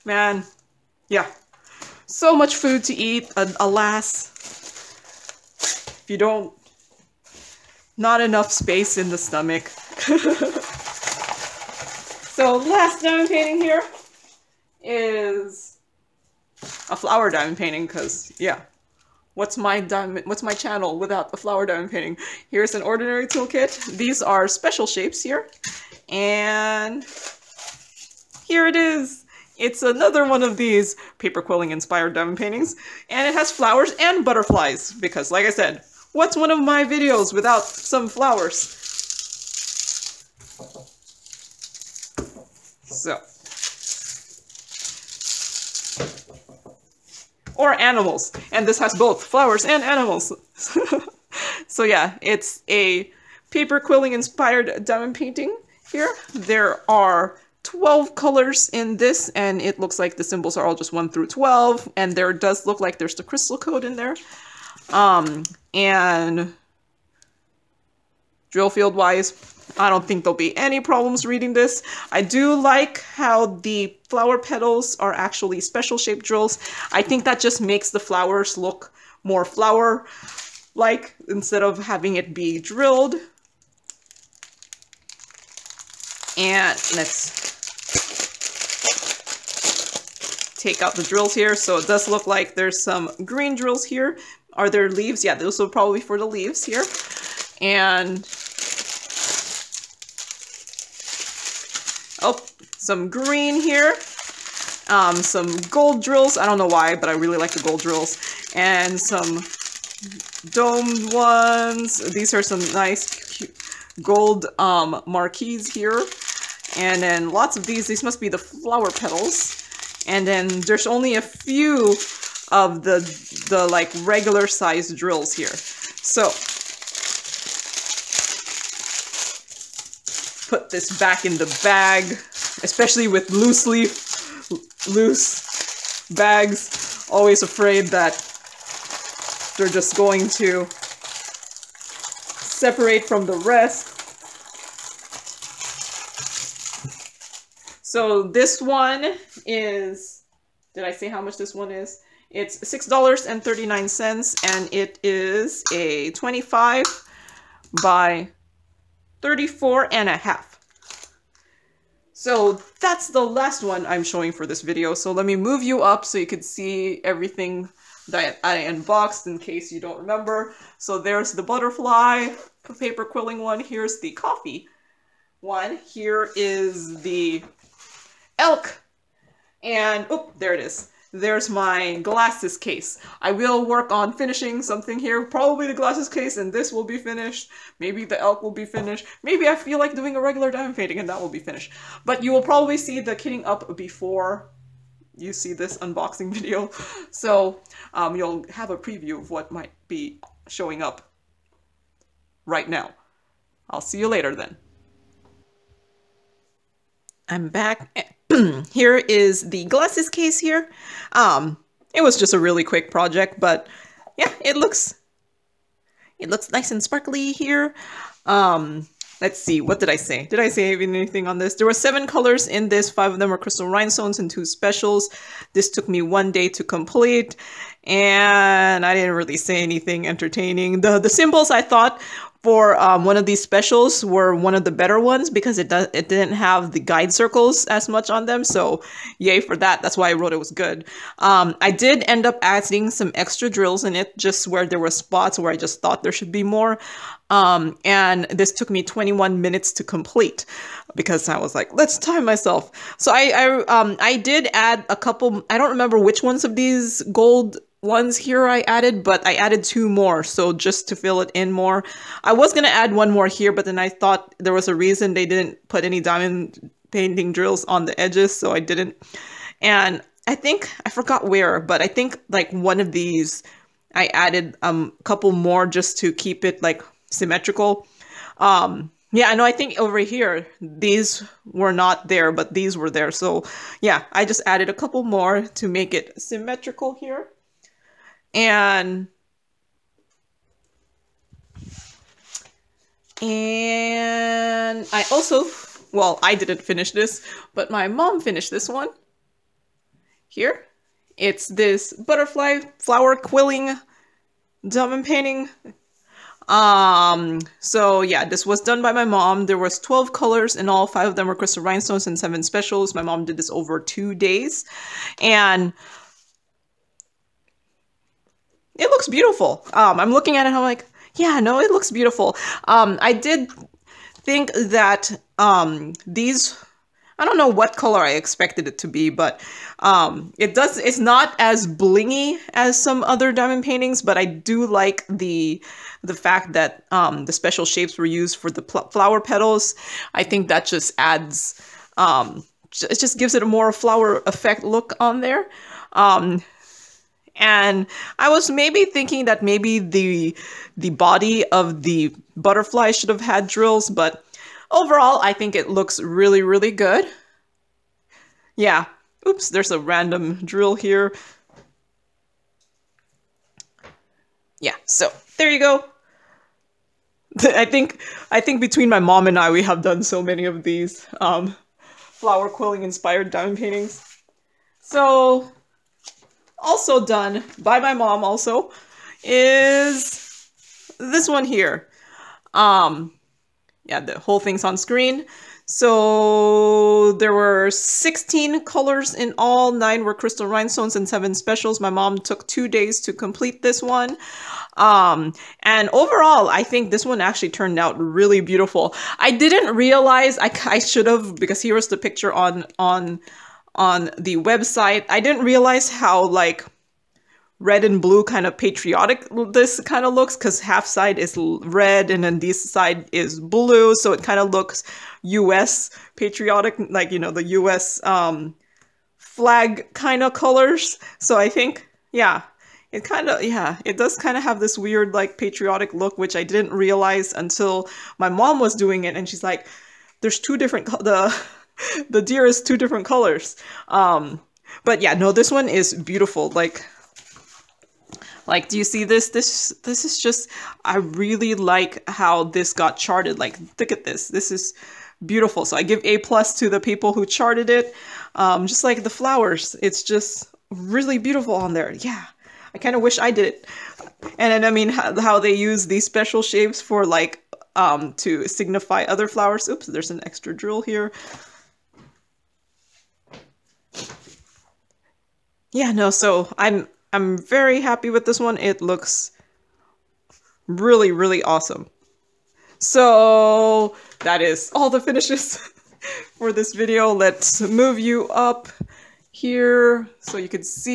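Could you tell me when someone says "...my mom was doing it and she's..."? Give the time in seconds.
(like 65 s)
428 s.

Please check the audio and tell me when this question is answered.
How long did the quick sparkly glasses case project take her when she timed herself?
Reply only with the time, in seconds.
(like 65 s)
248 s.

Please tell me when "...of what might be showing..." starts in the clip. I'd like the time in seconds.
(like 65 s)
199 s.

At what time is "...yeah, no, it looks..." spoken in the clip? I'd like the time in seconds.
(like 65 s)
321 s.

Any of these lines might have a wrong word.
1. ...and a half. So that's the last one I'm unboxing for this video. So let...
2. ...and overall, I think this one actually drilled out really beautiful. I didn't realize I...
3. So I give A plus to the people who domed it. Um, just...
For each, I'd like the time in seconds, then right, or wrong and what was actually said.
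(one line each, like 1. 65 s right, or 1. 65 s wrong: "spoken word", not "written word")
1. 159 s wrong: "showing", not "unboxing"
2. 395 s wrong: "turned", not "drilled"
3. 445 s wrong: "charted", not "domed".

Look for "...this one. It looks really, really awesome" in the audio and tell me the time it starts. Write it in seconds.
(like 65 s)
468 s.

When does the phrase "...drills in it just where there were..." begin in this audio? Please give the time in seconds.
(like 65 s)
243 s.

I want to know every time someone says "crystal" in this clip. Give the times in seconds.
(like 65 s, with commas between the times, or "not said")
63 s, 223 s, 311 s, 390 s.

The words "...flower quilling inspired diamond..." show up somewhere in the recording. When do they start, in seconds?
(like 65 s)
371 s.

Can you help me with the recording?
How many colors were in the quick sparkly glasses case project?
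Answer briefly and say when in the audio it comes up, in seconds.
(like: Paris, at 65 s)
7, at 221 s.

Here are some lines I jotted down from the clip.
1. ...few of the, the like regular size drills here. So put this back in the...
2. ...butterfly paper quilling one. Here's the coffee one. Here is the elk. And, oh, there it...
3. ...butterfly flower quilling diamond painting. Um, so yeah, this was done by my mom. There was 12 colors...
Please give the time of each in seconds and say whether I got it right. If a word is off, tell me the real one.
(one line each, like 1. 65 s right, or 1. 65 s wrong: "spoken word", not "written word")
1. 121 s right
2. 171 s right
3. 301 s right.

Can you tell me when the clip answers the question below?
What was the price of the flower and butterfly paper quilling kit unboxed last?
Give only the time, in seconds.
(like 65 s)
152 s.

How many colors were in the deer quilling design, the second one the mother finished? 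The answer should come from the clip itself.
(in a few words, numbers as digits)
16.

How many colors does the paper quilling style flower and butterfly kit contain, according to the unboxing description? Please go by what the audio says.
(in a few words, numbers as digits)
12.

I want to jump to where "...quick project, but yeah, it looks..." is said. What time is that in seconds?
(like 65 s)
212 s.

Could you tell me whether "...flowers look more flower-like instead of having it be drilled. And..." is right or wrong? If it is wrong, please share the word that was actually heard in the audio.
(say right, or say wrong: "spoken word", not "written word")
right.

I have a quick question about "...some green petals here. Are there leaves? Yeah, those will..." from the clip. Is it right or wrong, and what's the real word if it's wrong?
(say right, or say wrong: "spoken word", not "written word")
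wrong: "drills", not "petals".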